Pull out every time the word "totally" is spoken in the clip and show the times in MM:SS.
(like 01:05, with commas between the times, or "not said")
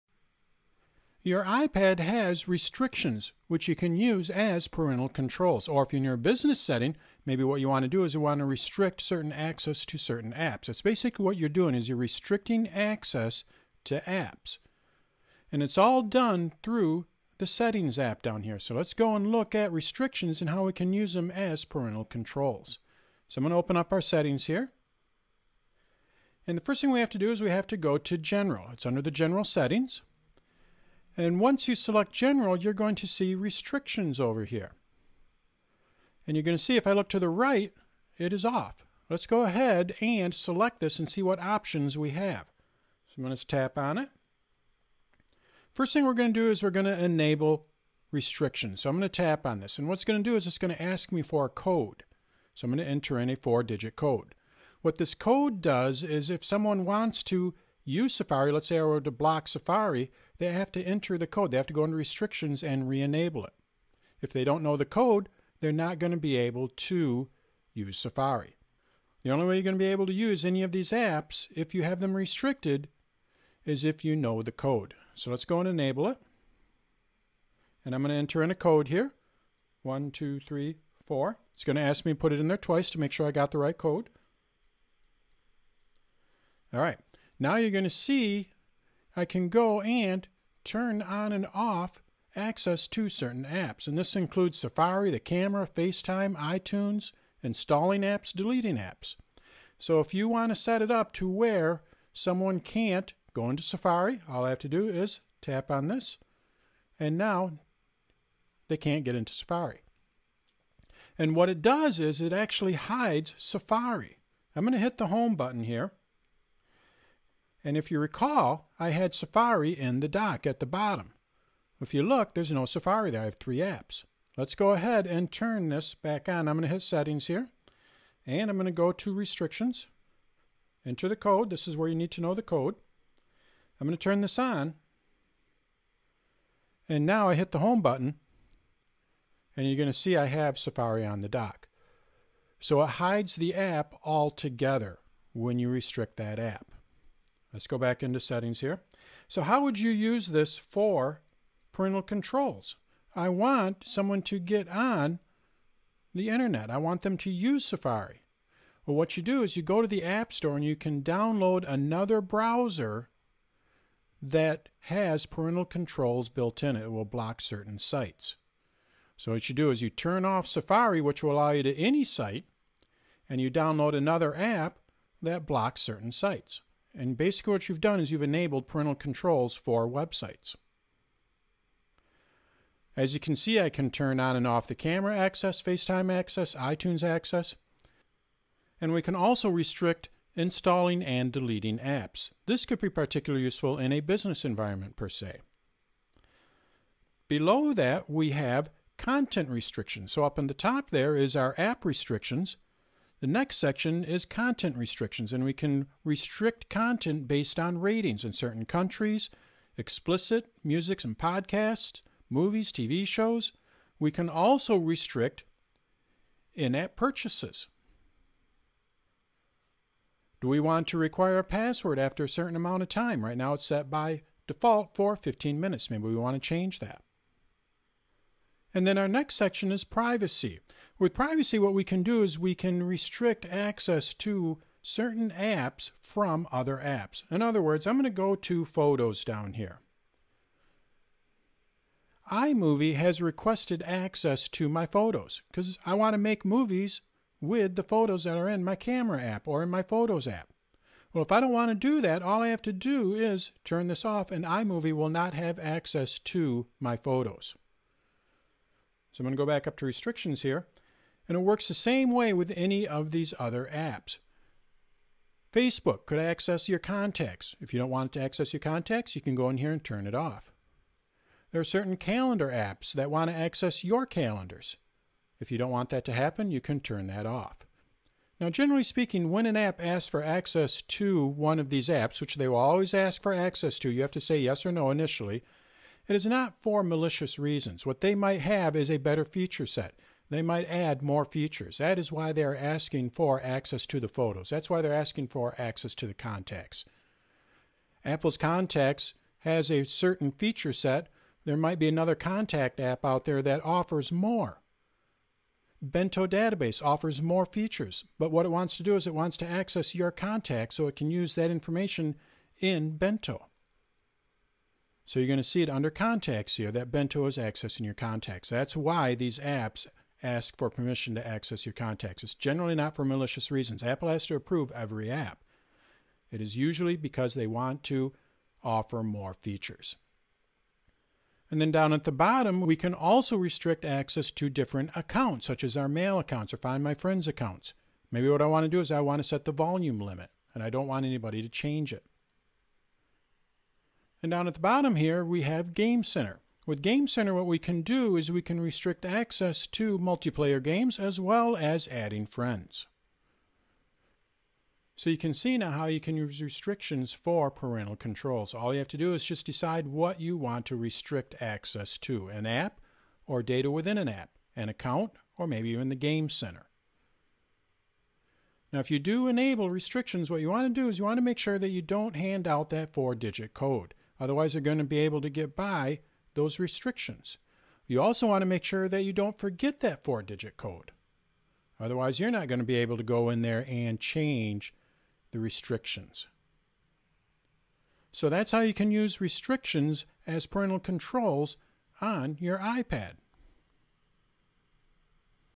not said.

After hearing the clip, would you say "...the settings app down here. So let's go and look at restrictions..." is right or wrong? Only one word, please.
right.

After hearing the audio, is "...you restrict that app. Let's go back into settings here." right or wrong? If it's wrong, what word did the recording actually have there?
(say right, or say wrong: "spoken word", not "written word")
right.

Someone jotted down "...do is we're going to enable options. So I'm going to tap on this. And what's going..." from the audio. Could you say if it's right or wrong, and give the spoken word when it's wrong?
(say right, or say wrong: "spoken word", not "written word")
wrong: "restrictions", not "options".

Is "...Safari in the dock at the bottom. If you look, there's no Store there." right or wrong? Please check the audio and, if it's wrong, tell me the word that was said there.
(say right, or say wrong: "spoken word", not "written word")
wrong: "Safari", not "Store".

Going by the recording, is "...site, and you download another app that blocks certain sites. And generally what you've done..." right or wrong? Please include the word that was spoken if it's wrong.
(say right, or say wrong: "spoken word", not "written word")
wrong: "basically", not "generally".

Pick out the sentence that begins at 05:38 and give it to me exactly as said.
Maybe what I want to do is I want to set the volume limit, and I don't want anybody to change it.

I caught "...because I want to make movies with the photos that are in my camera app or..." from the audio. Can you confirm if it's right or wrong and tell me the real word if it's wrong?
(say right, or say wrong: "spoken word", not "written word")
right.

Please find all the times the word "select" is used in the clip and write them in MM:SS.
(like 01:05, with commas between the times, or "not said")
00:31, 00:40.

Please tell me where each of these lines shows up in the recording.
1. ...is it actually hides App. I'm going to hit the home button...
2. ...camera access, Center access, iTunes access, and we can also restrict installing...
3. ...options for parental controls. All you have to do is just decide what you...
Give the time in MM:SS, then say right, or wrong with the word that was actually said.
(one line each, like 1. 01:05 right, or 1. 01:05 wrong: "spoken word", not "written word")
1. 01:51 wrong: "Safari", not "App"
2. 03:04 wrong: "FaceTime", not "Center"
3. 05:56 wrong: "restrictions", not "options".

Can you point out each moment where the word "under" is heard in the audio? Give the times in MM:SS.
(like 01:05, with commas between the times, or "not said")
00:28, 05:15.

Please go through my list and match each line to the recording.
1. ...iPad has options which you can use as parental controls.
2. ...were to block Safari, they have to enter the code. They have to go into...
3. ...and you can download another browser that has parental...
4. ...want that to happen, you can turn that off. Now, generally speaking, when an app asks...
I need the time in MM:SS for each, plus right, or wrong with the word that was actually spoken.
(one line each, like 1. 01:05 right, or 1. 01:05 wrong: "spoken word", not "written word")
1. 00:01 wrong: "restrictions", not "options"
2. 00:58 right
3. 02:40 right
4. 04:35 right.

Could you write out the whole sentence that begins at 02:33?
I want someone to get on the internet.